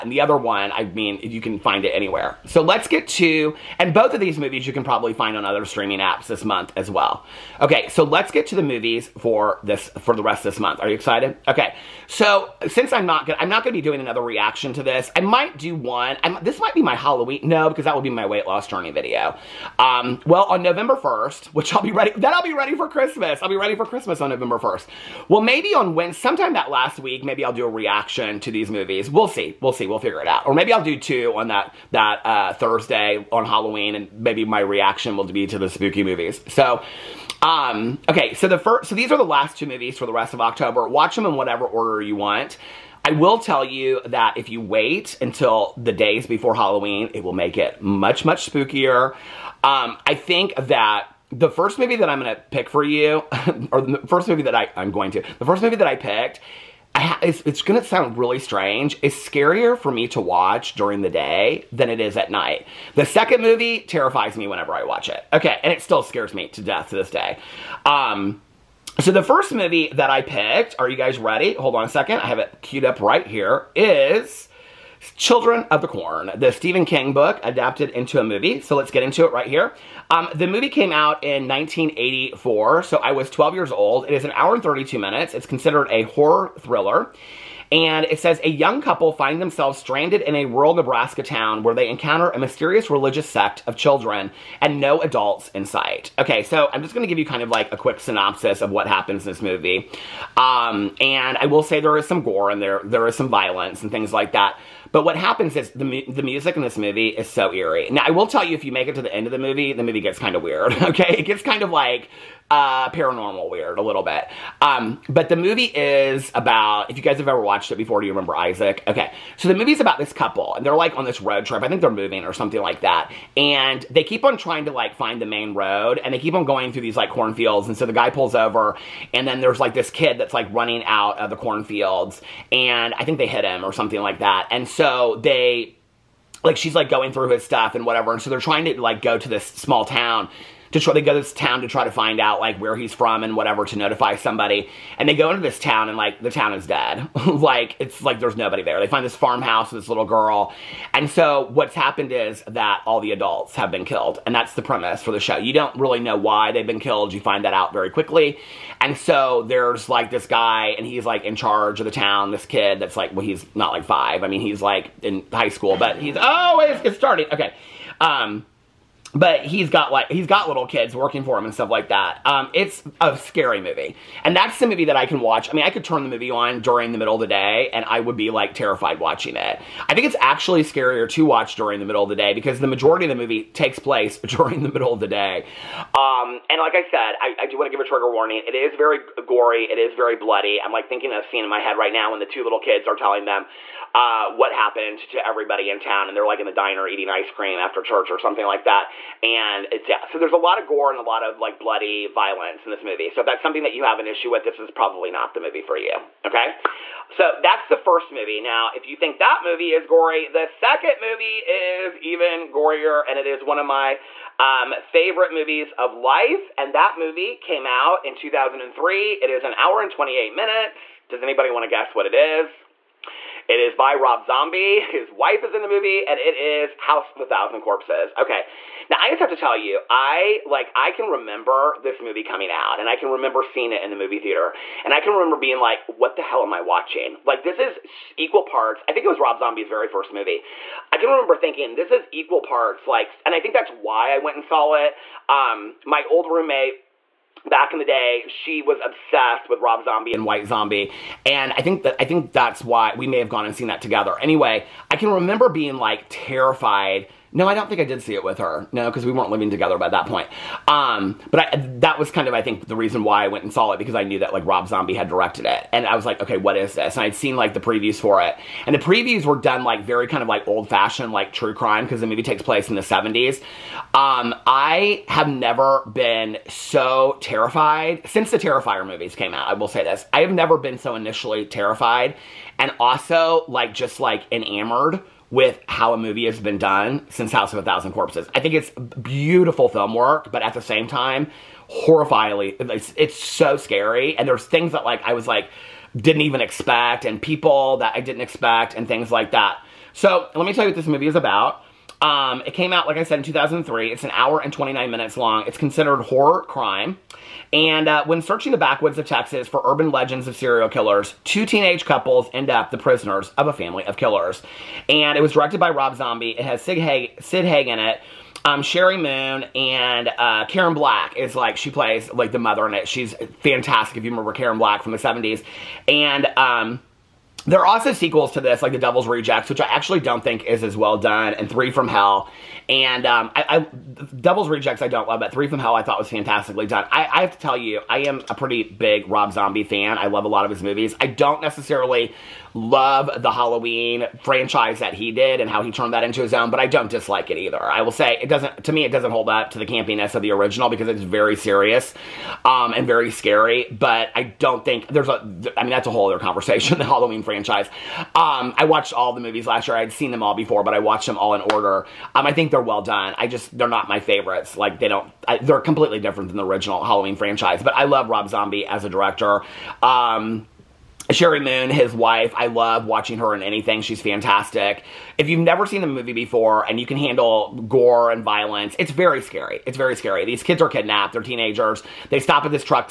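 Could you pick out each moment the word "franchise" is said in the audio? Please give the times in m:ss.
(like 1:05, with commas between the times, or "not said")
5:44, 5:57, 6:07.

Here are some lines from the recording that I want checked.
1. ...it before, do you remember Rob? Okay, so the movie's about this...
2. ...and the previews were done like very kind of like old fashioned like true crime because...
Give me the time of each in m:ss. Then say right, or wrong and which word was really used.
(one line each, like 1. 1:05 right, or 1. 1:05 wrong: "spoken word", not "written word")
1. 1:57 wrong: "Isaac", not "Rob"
2. 4:28 right.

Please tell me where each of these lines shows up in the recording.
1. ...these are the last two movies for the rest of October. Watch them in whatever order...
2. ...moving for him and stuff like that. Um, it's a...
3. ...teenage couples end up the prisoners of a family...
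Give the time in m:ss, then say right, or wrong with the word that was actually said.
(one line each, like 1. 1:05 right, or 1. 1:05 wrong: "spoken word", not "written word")
1. 0:38 right
2. 2:50 wrong: "working", not "moving"
3. 5:11 right.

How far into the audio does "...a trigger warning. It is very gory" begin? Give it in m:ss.
3:07.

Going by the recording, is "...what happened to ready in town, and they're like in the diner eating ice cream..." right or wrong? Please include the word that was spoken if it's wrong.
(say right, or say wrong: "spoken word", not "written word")
wrong: "everybody", not "ready".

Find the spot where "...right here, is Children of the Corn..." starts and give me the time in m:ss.
1:13.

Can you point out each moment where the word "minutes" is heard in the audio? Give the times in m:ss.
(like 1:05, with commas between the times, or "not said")
1:24, 3:40, 5:04.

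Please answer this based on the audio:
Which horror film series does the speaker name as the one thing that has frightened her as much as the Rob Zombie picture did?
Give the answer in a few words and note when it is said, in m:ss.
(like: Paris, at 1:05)
Terrifier, at 4:38.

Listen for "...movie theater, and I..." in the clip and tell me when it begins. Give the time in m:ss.
3:53.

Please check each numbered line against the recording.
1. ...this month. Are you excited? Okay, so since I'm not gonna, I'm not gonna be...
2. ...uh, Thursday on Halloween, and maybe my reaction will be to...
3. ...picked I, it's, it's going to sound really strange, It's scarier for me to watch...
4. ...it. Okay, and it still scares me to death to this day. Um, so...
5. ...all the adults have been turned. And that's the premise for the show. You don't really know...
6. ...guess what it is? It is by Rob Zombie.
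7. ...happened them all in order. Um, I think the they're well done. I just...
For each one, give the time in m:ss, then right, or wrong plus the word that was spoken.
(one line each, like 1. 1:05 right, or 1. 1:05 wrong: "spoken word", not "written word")
1. 0:10 right
2. 0:32 right
3. 0:55 right
4. 1:05 right
5. 2:32 wrong: "killed", not "turned"
6. 3:41 right
7. 6:00 wrong: "watched", not "happened".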